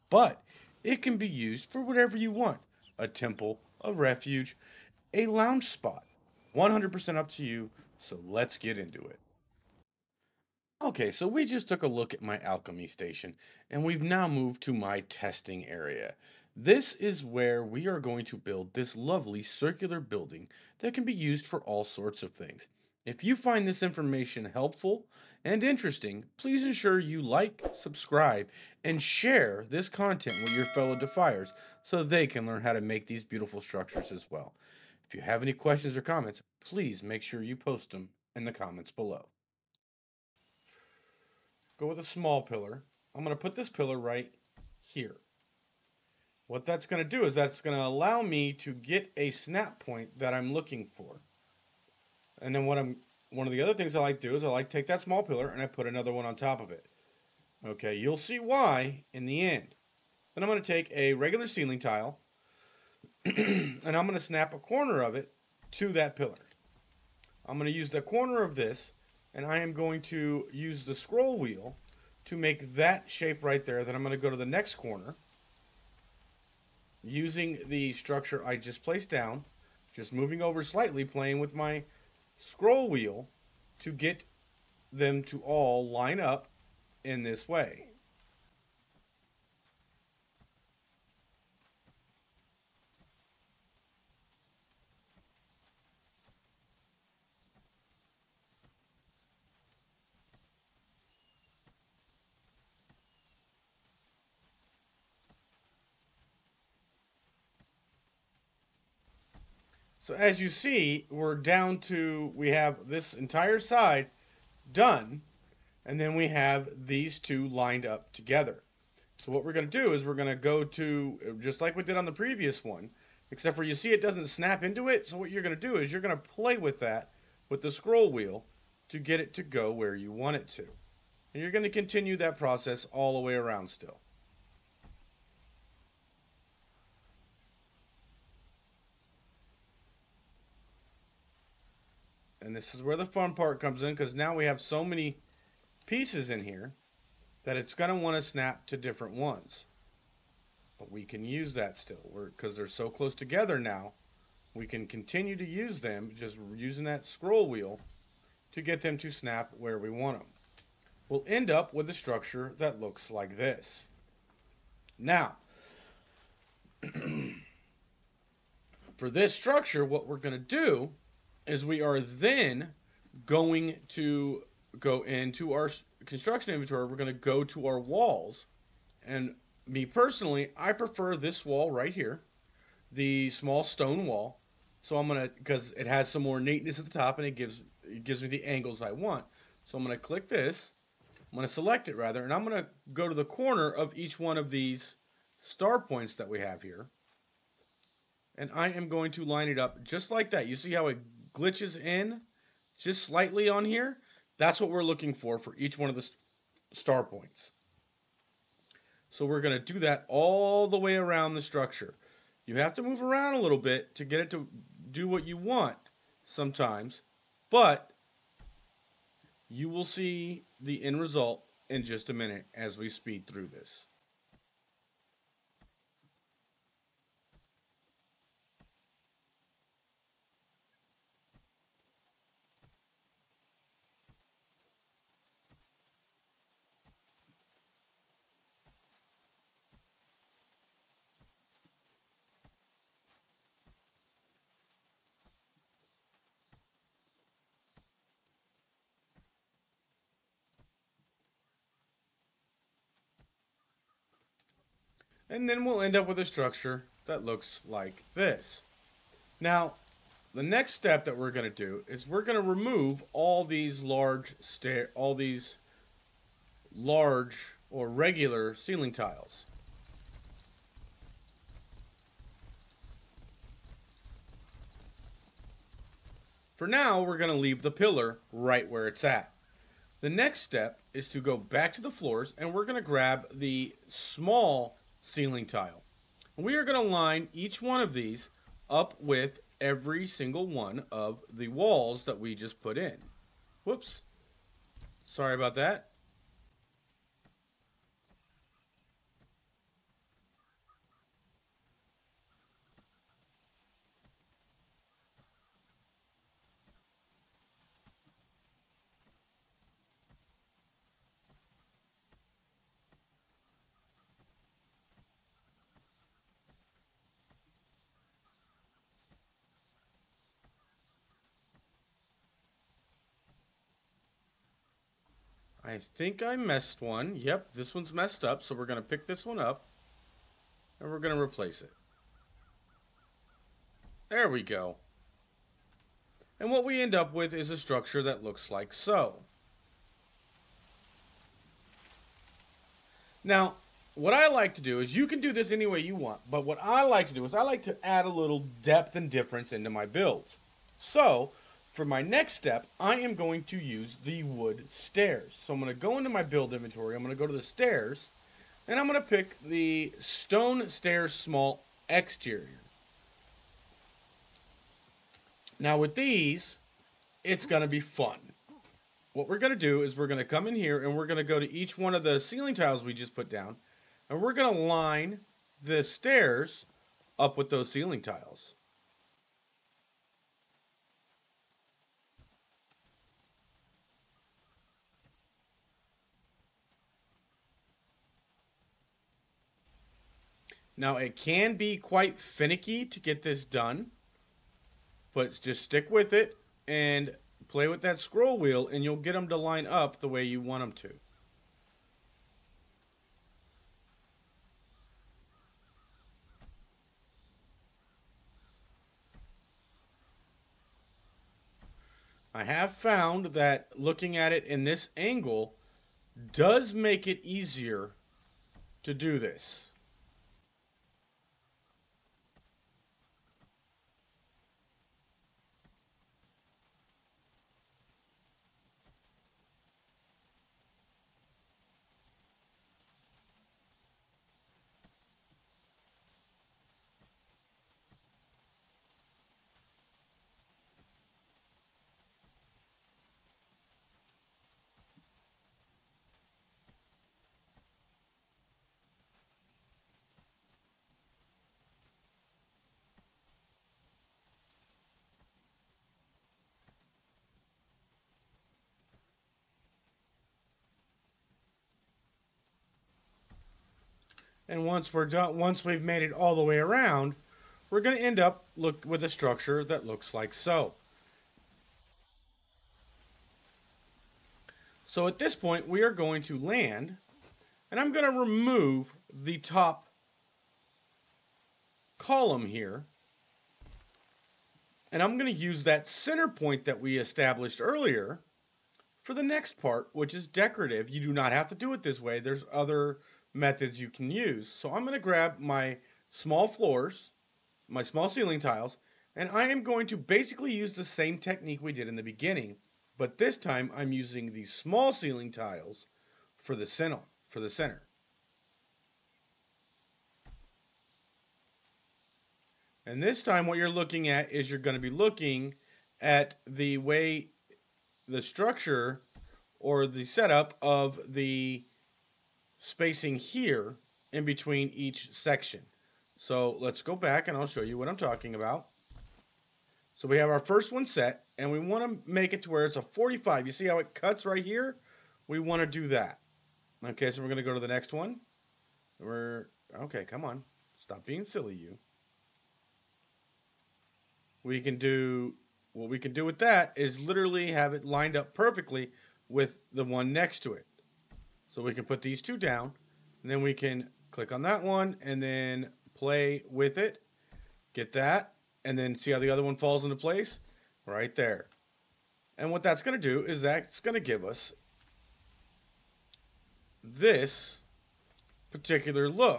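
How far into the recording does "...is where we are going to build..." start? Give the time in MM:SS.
00:16.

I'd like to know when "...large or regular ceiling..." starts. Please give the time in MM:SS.
04:26.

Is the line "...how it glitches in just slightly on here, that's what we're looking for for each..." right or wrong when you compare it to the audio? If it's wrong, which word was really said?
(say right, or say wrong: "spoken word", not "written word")
right.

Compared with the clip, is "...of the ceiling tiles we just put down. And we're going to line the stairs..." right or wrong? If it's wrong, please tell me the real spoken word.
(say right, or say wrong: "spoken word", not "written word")
right.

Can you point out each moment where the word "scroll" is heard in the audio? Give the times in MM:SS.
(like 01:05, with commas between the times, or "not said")
01:10, 01:22, 02:07, 02:37, 06:37.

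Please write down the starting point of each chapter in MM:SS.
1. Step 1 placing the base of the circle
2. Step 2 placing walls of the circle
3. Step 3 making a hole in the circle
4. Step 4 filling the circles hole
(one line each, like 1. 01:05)
1. 00:42
2. 02:54
3. 04:14
4. 05:46.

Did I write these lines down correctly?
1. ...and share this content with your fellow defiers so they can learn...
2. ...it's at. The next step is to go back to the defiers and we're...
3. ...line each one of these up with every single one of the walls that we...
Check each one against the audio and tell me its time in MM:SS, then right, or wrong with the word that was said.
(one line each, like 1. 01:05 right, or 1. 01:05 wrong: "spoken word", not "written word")
1. 00:28 right
2. 04:38 wrong: "floors", not "defiers"
3. 04:46 right.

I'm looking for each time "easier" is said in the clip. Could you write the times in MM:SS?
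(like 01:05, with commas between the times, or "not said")
06:57.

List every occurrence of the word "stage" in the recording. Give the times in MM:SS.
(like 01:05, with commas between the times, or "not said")
not said.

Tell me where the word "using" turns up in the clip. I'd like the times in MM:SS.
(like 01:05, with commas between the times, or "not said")
01:17, 02:36, 08:23.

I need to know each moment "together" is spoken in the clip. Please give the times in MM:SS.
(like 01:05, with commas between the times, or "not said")
01:58, 02:33.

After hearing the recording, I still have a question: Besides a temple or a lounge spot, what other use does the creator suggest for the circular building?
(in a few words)
A refuge.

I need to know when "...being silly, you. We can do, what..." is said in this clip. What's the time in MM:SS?
09:01.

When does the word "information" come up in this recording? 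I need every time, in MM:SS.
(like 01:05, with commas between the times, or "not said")
00:23.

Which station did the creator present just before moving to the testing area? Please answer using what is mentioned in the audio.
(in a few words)
Alchemy station.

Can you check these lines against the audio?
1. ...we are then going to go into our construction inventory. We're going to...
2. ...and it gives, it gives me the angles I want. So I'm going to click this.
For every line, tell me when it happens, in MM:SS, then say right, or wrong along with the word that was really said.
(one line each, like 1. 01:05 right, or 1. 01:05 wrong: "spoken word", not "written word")
1. 02:51 right
2. 03:07 right.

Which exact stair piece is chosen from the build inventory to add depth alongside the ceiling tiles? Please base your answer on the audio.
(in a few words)
Stone stairs small exterior.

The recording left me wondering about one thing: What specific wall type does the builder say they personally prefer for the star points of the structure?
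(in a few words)
Small stone wall.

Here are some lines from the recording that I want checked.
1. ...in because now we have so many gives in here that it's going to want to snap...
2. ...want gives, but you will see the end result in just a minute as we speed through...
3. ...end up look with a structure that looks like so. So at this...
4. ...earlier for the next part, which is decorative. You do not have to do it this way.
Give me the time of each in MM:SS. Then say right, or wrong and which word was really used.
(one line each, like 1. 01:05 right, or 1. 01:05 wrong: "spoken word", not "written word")
1. 02:23 wrong: "pieces", not "gives"
2. 03:35 wrong: "sometimes", not "gives"
3. 07:48 right
4. 08:07 right.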